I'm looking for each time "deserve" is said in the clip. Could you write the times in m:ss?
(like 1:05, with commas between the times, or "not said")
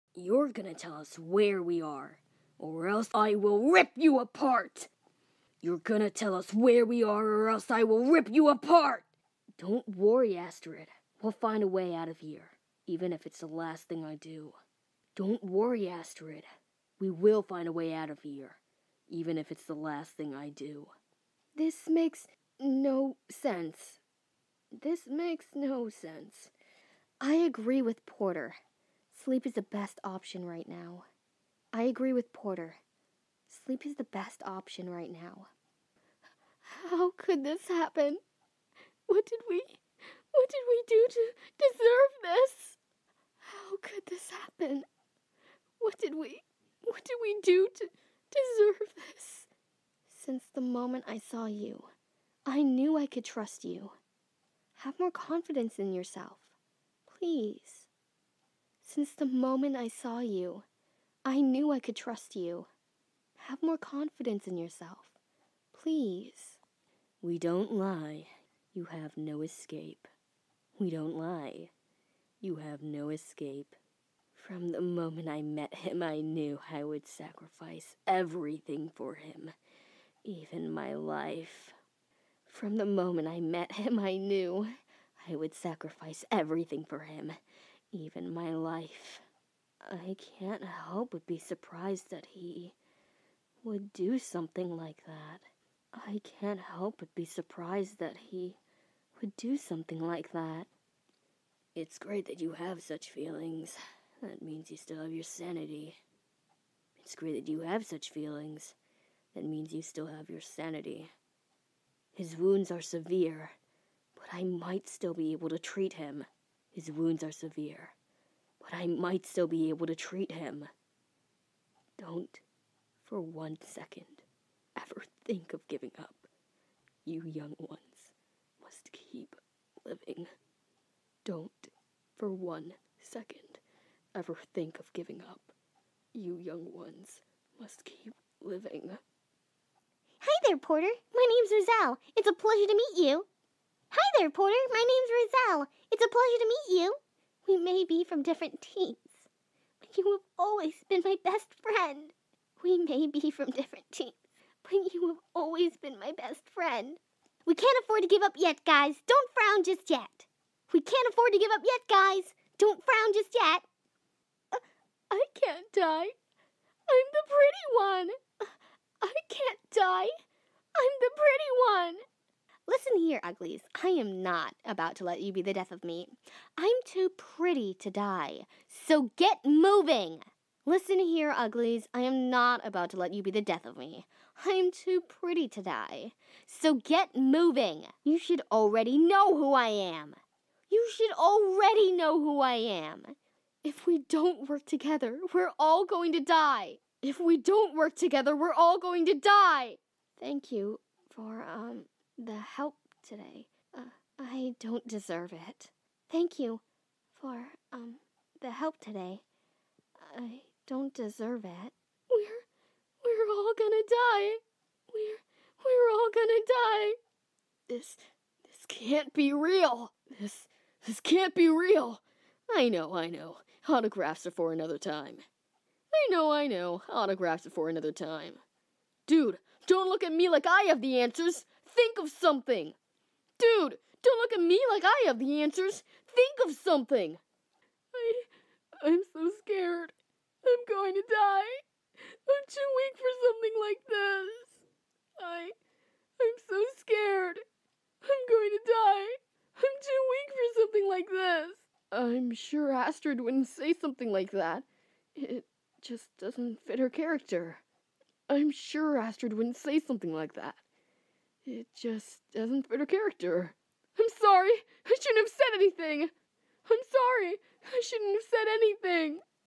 0:41, 0:48, 3:24, 3:30.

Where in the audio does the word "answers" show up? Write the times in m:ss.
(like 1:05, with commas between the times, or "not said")
3:50, 3:55.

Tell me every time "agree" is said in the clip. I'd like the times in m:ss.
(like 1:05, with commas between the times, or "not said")
0:27, 0:31.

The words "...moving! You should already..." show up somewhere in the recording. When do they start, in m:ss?
3:07.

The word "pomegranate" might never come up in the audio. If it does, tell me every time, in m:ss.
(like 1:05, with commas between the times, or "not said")
not said.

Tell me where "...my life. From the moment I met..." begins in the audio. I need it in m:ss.
1:20.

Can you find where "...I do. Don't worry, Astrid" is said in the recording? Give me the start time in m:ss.
0:14.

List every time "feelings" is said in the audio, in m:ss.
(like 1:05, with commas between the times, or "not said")
1:43, 1:48.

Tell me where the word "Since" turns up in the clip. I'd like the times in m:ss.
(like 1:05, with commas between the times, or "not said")
0:50, 0:58.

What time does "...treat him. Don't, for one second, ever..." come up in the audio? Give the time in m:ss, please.
1:59.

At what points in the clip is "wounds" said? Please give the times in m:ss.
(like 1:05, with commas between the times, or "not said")
1:52, 1:56.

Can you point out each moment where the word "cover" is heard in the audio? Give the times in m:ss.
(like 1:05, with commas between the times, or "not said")
not said.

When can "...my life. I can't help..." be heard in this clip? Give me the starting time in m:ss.
1:28.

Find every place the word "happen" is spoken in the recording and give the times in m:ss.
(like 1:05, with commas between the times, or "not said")
0:37, 0:44.